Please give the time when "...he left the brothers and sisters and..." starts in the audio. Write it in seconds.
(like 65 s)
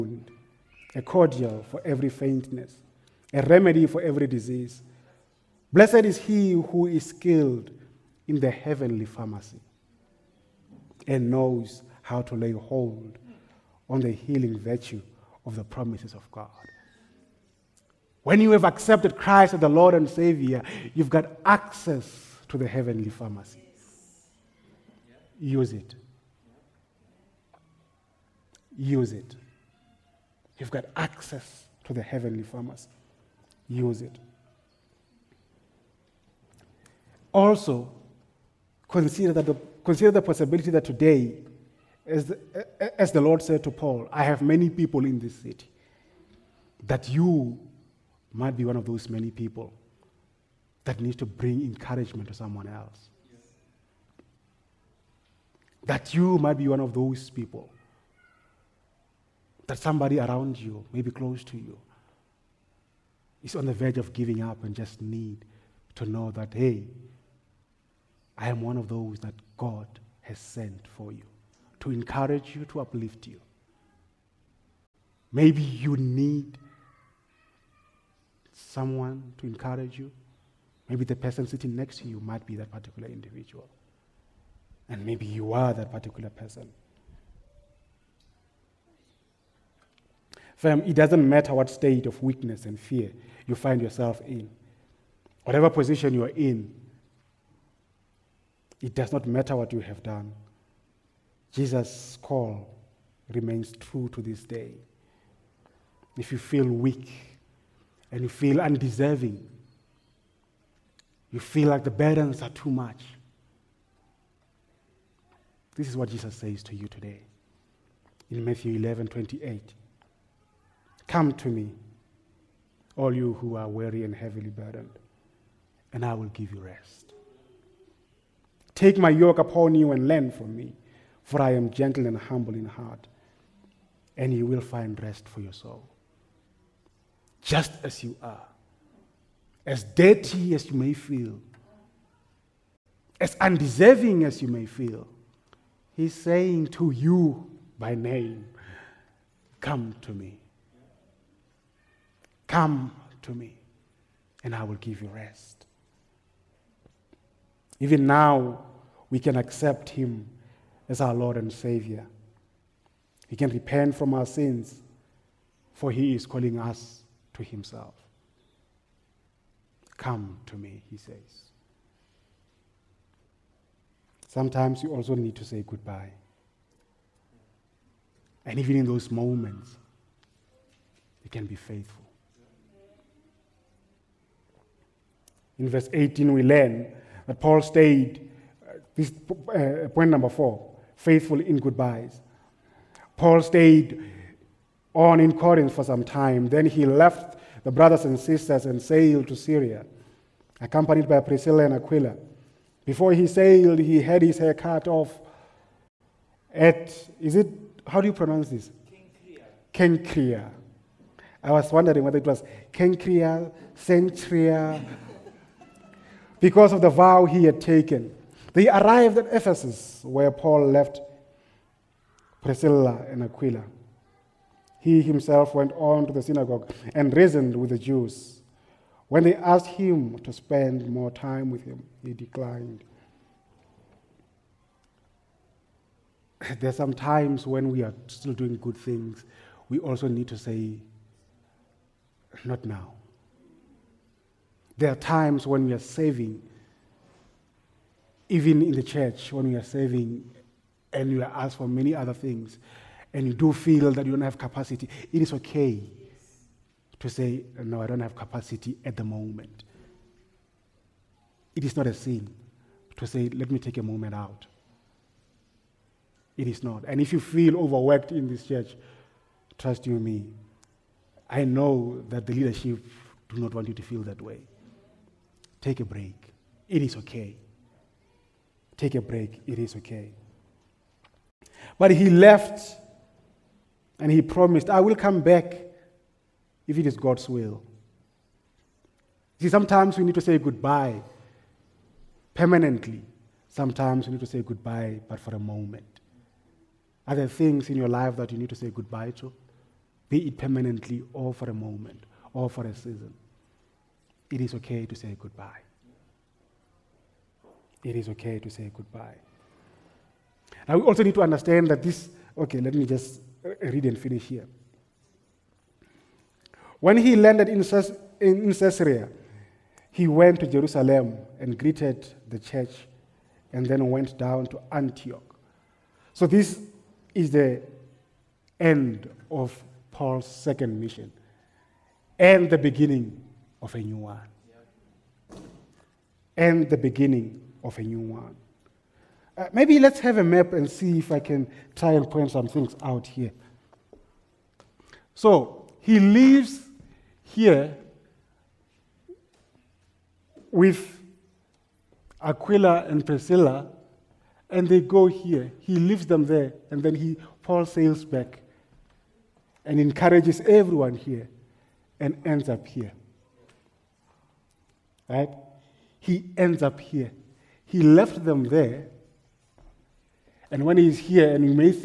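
196 s.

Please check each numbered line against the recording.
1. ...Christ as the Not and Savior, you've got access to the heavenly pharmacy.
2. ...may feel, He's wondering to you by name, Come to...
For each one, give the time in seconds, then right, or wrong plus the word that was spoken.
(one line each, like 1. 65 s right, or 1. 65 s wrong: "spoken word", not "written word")
1. 19 s wrong: "Lord", not "Not"
2. 144 s wrong: "saying", not "wondering".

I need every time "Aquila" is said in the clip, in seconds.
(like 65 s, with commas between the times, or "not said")
201 s, 223 s, 352 s.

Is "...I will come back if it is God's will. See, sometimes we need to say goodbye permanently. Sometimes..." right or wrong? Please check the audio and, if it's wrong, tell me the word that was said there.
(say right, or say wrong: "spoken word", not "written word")
right.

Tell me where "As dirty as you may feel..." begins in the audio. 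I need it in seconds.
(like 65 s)
139 s.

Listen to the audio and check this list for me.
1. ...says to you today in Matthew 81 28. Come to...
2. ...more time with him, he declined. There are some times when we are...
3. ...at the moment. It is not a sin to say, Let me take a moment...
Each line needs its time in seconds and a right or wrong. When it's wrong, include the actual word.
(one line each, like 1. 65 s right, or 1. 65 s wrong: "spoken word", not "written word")
1. 116 s wrong: "11", not "81"
2. 230 s right
3. 258 s right.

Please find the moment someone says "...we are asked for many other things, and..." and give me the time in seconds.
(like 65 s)
251 s.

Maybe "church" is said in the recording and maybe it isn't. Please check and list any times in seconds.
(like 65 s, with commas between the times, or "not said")
248 s, 268 s, 322 s.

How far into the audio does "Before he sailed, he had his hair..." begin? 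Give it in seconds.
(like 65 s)
202 s.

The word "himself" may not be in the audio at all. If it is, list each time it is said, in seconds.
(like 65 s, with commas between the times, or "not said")
167 s, 225 s.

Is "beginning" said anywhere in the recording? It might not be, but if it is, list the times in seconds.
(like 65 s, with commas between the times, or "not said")
332 s, 336 s.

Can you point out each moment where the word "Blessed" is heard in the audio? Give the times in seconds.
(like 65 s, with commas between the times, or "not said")
5 s.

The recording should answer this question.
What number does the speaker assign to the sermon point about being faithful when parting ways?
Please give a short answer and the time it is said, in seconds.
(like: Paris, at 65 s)
4, at 190 s.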